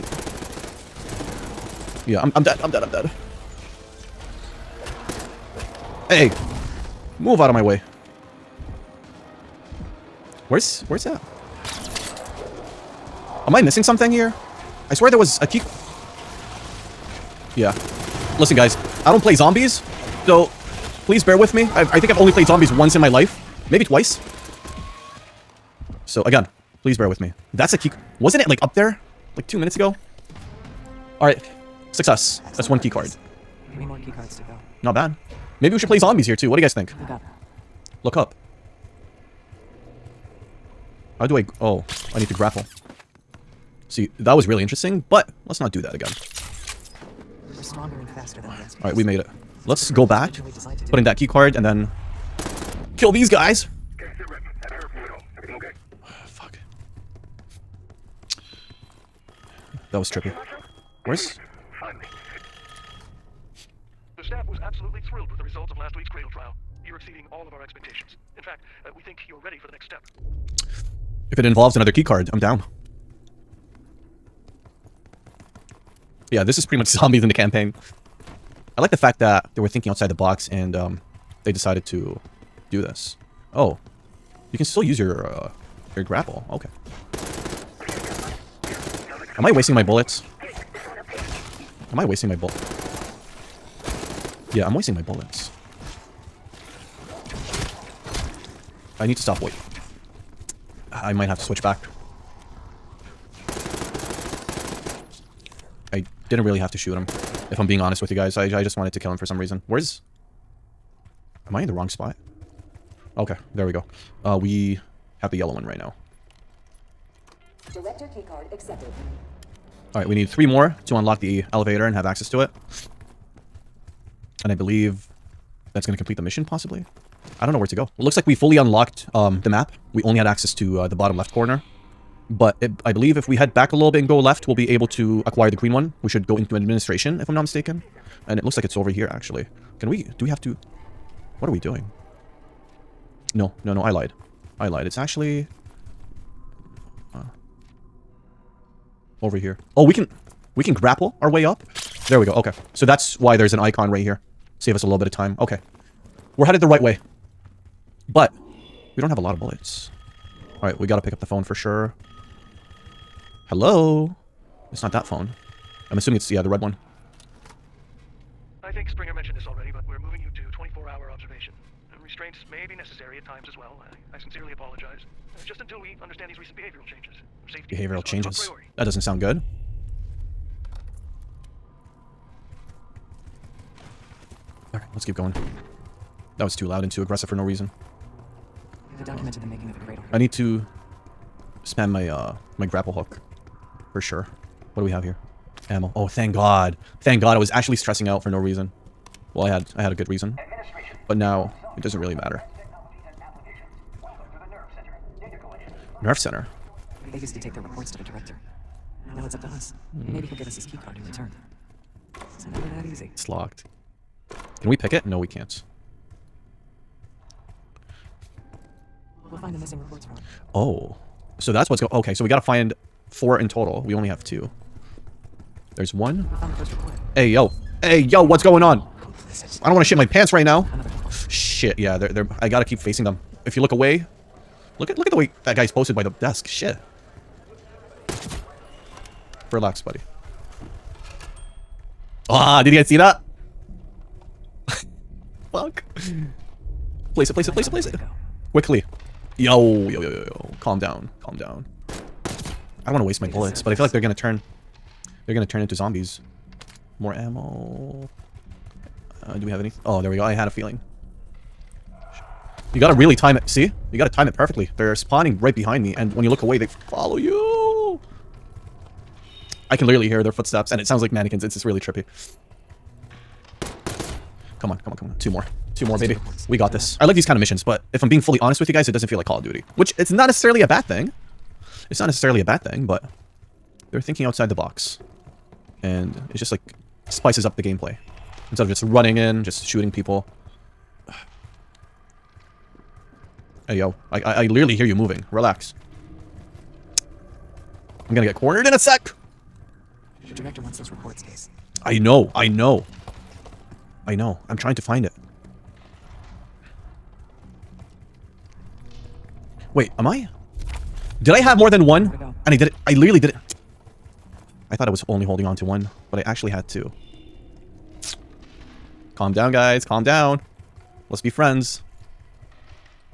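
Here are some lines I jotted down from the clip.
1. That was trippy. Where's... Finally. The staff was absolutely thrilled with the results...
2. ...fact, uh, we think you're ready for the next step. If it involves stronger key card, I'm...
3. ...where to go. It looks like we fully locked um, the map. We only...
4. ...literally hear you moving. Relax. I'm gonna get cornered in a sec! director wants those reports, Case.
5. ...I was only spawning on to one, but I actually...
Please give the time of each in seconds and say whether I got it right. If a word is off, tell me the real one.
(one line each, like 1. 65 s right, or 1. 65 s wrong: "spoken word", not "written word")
1. 59 s right
2. 68 s wrong: "another", not "stronger"
3. 127 s wrong: "unlocked", not "locked"
4. 294 s right
5. 314 s wrong: "holding", not "spawning".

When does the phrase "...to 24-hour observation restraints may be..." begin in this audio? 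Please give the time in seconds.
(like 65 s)
170 s.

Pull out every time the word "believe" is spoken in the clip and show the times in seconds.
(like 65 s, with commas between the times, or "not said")
124 s, 132 s.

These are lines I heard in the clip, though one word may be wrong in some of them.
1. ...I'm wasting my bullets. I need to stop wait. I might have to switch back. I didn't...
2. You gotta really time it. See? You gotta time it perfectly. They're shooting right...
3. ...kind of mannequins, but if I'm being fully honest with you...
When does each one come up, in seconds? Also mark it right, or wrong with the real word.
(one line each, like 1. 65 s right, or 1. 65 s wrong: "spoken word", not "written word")
1. 94 s right
2. 262 s wrong: "spawning", not "shooting"
3. 277 s wrong: "missions", not "mannequins".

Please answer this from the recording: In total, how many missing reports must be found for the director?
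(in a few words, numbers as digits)
4.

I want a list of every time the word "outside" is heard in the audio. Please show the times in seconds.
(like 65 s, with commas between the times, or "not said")
79 s, 284 s.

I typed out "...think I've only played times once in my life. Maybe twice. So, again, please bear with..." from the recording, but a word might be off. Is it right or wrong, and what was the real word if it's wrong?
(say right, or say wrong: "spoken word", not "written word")
wrong: "zombies", not "times".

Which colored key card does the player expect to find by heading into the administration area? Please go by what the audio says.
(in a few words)
green.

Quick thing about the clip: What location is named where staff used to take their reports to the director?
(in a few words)
Nerve Center.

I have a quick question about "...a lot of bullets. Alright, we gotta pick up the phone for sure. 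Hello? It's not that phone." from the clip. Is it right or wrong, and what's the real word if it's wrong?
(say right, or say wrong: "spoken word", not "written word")
right.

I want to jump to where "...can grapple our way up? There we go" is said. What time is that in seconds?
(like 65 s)
150 s.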